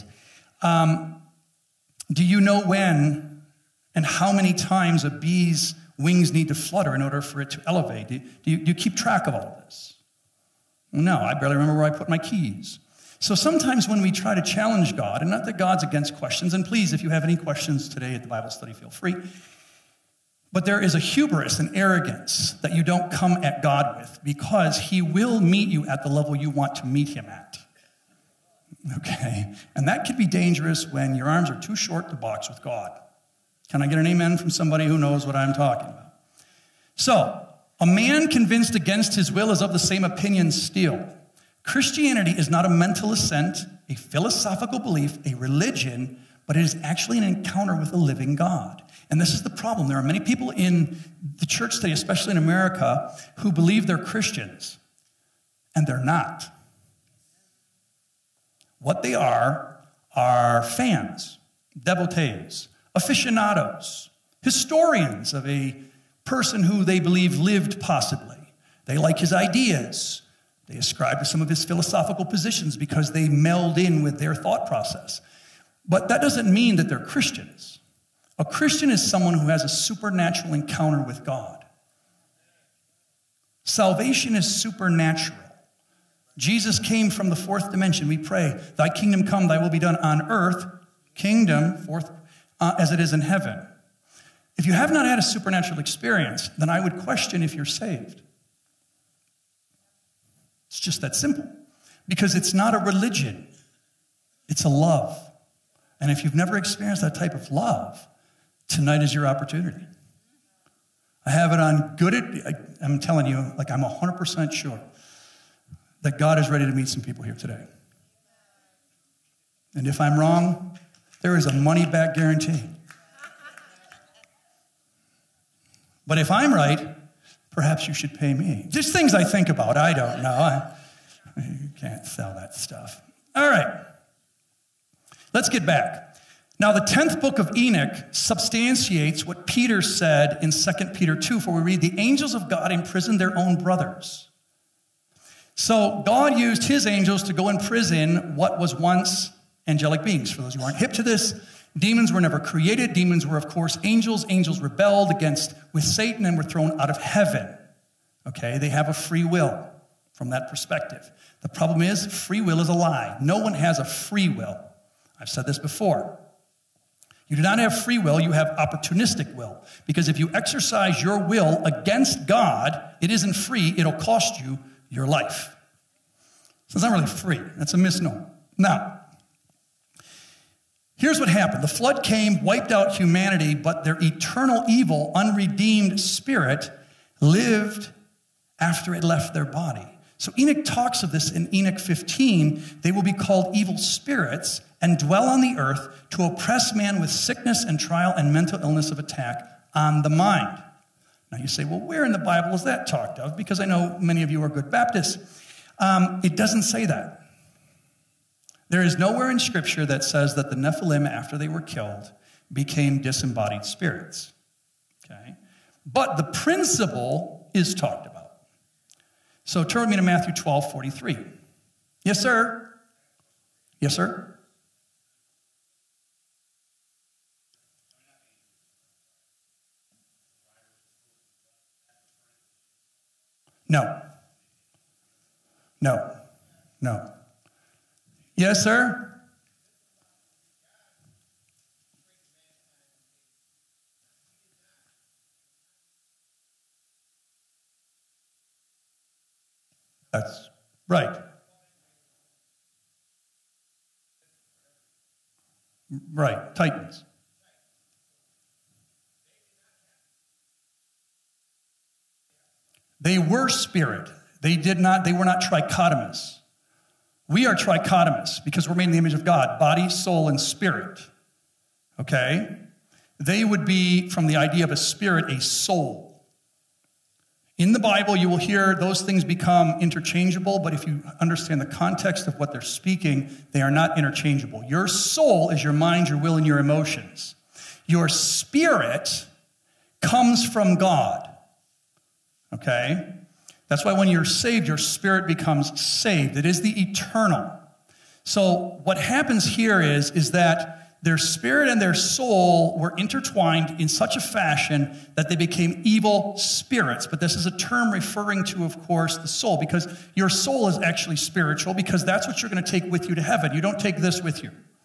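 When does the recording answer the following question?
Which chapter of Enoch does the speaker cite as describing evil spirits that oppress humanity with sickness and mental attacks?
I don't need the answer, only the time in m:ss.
3:11.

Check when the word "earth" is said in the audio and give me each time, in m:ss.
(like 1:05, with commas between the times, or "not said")
1:30, 3:15.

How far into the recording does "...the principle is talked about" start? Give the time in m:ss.
3:36.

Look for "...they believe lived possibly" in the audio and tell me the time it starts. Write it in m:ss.
1:06.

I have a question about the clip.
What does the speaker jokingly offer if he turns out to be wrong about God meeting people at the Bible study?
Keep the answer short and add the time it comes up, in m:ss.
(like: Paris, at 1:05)
money back guarantee, at 2:01.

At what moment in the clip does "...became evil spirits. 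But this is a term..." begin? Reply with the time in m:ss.
5:05.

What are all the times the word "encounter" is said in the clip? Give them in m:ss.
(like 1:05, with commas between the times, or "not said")
0:47, 1:20.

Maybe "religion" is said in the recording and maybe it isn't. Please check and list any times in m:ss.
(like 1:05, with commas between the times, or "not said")
0:45, 1:42.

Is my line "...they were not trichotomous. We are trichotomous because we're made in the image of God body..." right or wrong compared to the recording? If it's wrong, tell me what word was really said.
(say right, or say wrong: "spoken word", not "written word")
right.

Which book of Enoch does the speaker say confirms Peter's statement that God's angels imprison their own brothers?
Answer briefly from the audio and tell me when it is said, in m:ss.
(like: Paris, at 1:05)
the 10th book, at 2:16.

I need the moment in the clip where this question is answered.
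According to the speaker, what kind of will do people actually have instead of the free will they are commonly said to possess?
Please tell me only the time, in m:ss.
2:48.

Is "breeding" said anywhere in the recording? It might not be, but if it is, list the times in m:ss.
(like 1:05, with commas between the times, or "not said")
not said.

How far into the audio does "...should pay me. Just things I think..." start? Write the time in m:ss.
2:07.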